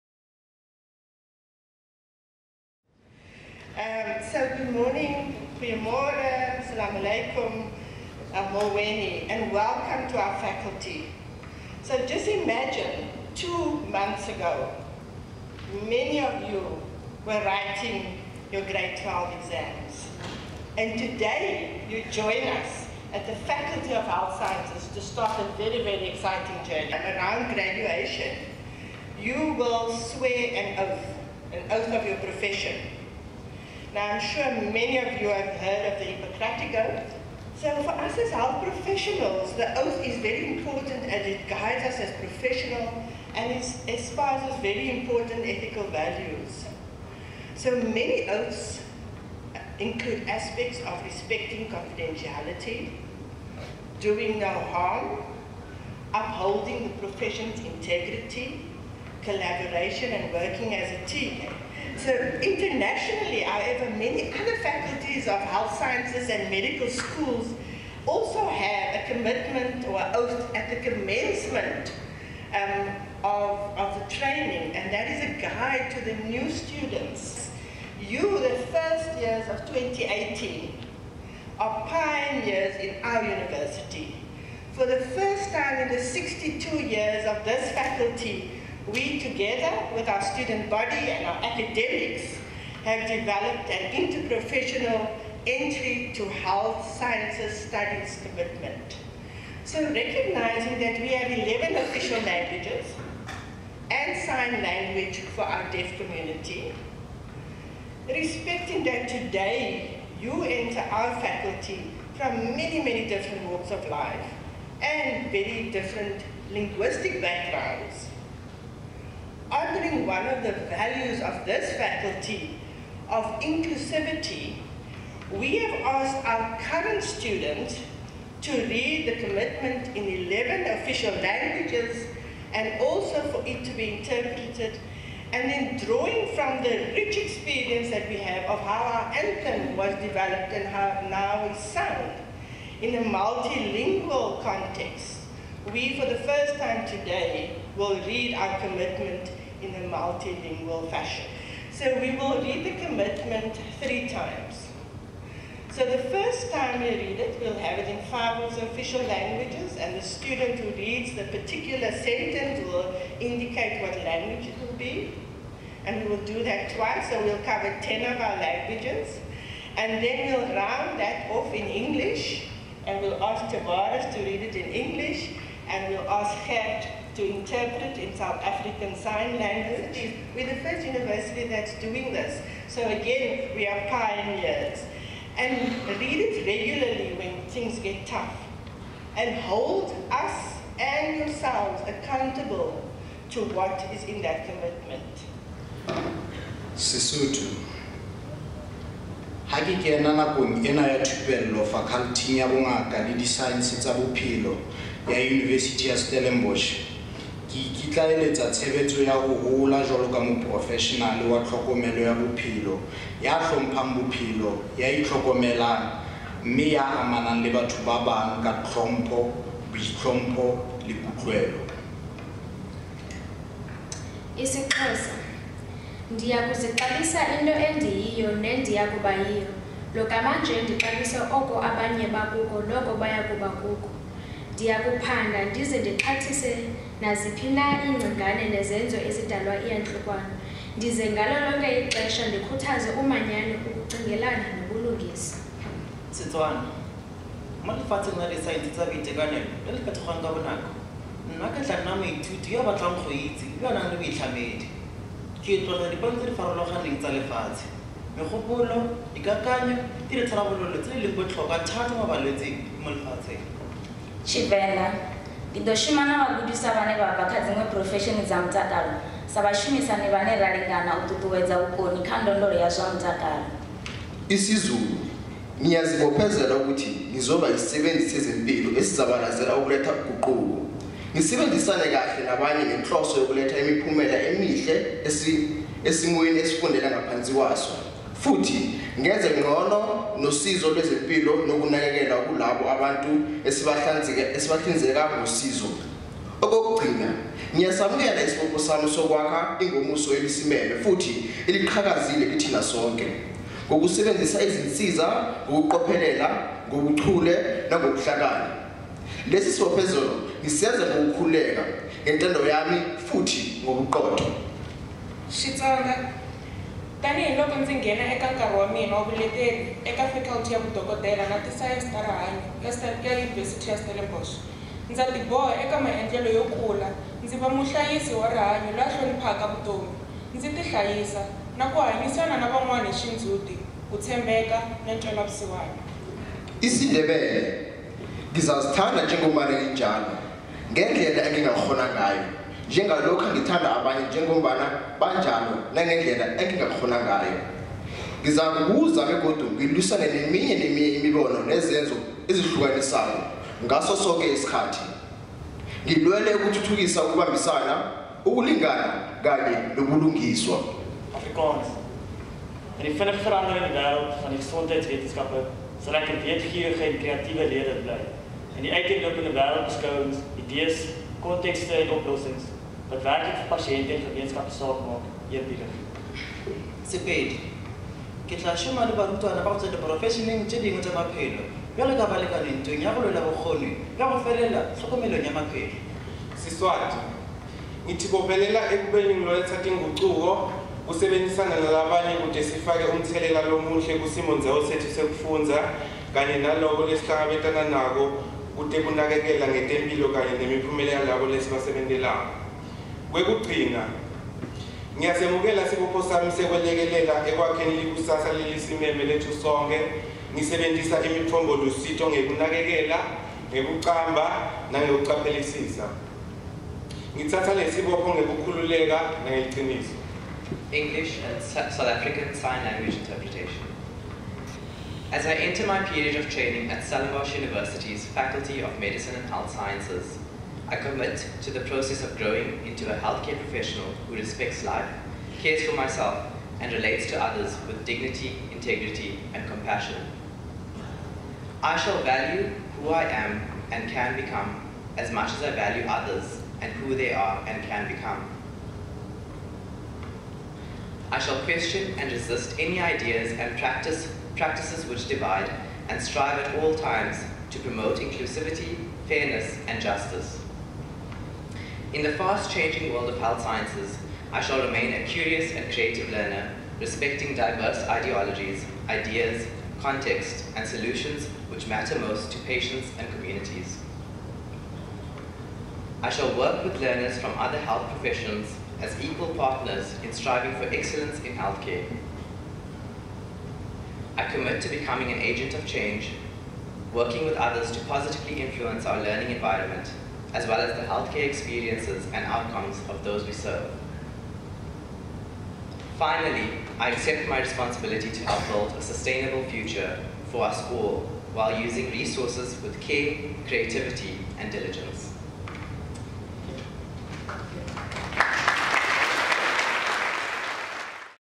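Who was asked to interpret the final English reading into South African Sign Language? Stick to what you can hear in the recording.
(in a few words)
Gert.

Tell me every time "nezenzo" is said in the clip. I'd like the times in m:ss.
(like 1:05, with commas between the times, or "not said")
3:58, 5:51.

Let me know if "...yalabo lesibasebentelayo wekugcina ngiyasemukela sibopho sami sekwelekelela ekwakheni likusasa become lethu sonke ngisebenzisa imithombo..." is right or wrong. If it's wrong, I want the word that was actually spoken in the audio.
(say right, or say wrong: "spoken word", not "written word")
wrong: "lelisimeme", not "become".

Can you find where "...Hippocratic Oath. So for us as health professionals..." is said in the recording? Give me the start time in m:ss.
0:36.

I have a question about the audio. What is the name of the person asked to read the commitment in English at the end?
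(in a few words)
Tavares.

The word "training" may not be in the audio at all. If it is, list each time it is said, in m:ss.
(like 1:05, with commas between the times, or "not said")
1:14, 7:06.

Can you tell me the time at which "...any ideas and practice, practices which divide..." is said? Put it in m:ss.
7:32.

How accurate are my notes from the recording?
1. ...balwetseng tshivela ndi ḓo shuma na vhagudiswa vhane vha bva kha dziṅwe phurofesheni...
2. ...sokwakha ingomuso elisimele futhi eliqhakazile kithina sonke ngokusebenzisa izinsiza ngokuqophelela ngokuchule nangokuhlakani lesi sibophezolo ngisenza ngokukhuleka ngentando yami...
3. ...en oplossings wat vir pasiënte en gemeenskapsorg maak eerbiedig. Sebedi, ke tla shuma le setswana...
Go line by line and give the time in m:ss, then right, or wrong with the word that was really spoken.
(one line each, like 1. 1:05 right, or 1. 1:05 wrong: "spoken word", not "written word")
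1. 4:22 wrong: "lefatsheng", not "balwetseng"
2. 4:58 right
3. 6:11 wrong: "barutwana", not "setswana".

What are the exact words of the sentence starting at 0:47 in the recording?
So many oaths include aspects of respecting confidentiality, doing no harm, upholding the profession's integrity, collaboration and working as a team.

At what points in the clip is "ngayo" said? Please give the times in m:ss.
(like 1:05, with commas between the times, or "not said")
5:41, 5:47.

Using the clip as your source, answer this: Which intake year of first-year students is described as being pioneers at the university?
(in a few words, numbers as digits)
2018.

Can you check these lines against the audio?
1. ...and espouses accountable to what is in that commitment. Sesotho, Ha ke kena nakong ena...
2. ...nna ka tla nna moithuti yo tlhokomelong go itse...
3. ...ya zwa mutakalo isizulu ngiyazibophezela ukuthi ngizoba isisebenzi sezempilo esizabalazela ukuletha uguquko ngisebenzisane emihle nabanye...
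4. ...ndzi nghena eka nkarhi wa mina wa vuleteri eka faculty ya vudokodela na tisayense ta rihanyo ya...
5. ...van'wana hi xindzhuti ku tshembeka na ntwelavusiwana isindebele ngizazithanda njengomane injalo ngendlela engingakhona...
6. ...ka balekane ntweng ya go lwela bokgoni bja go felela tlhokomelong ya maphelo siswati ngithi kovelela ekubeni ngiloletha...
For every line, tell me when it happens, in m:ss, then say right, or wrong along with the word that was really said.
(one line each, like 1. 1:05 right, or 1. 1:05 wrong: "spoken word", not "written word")
1. 3:10 wrong: "yourselves", not "espouses"
2. 4:11 wrong: "batlang", not "tlhokomelong"
3. 4:32 wrong: "kahle", not "emihle"
4. 5:17 right
5. 5:32 right
6. 6:21 right.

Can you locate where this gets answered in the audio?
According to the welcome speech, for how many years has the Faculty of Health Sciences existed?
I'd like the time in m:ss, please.
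1:26.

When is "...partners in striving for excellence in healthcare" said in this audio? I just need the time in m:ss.
7:59.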